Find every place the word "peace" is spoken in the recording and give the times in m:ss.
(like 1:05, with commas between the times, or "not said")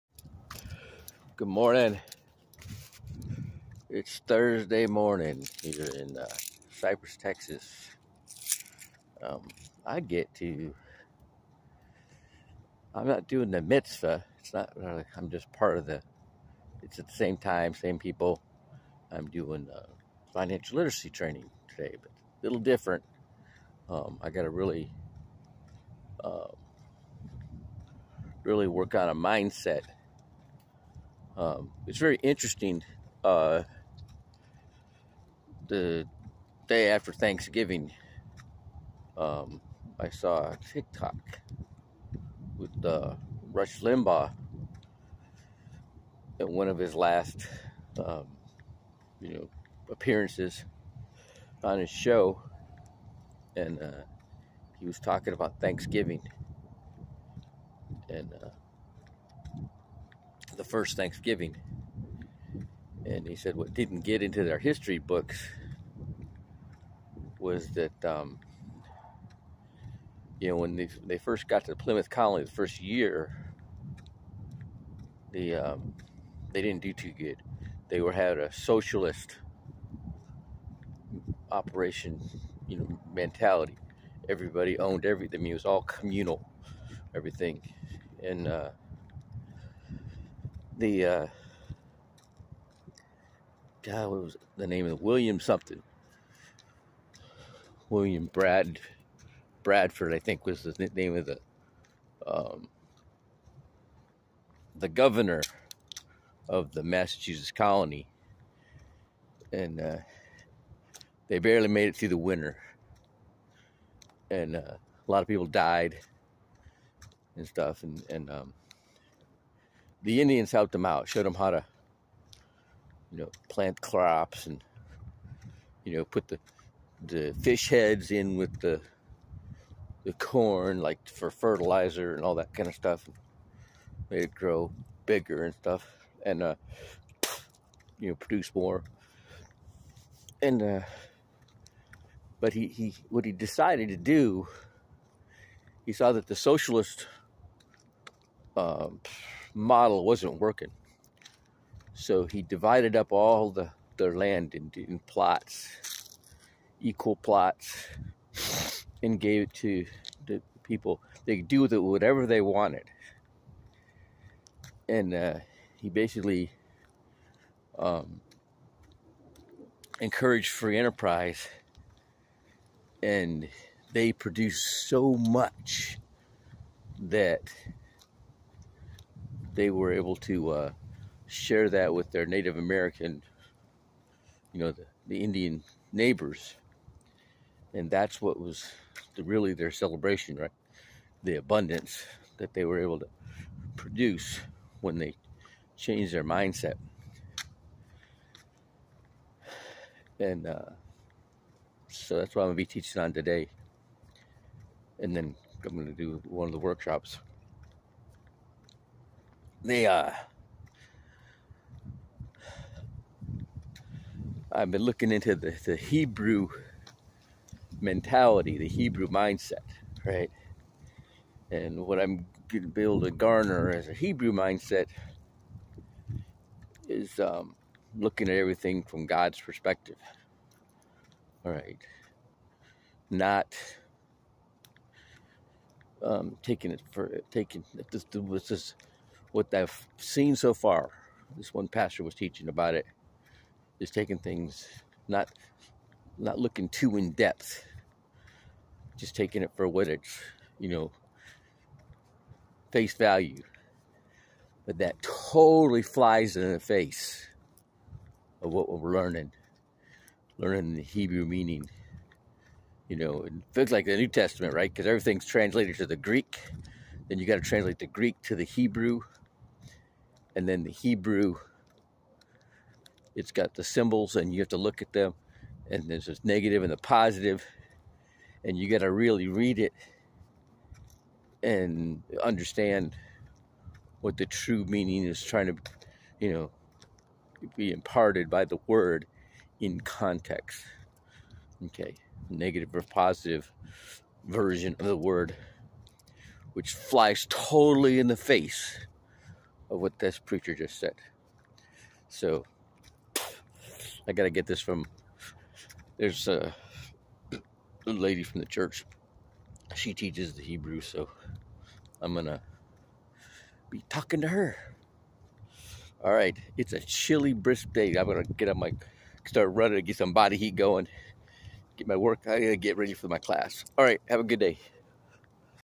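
not said.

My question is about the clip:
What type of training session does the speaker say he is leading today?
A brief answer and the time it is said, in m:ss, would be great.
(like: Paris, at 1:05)
financial literacy training, at 0:20.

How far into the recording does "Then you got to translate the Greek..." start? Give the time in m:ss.
4:27.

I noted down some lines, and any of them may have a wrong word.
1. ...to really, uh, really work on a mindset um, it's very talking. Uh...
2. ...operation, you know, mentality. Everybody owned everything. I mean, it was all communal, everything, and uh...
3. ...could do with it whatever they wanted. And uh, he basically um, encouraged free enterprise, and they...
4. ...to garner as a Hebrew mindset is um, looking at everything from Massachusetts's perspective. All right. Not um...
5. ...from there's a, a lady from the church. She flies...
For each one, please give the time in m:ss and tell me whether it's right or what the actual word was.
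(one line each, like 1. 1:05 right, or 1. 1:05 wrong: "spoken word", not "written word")
1. 0:24 wrong: "interesting", not "talking"
2. 1:21 right
3. 2:41 right
4. 3:43 wrong: "God", not "Massachusetts"
5. 5:04 wrong: "teaches", not "flies".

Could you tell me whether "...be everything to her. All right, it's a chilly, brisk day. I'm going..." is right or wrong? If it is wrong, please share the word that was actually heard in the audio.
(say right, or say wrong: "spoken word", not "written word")
wrong: "talking", not "everything".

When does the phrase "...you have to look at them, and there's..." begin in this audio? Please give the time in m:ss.
4:34.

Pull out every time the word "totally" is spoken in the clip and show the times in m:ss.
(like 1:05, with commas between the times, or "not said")
4:15, 4:57.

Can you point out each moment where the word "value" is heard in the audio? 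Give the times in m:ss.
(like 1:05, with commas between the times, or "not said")
4:12.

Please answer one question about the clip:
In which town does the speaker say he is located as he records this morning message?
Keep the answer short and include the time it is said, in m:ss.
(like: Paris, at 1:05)
Cypress, Texas, at 0:06.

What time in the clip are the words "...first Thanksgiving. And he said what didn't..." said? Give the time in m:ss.
1:00.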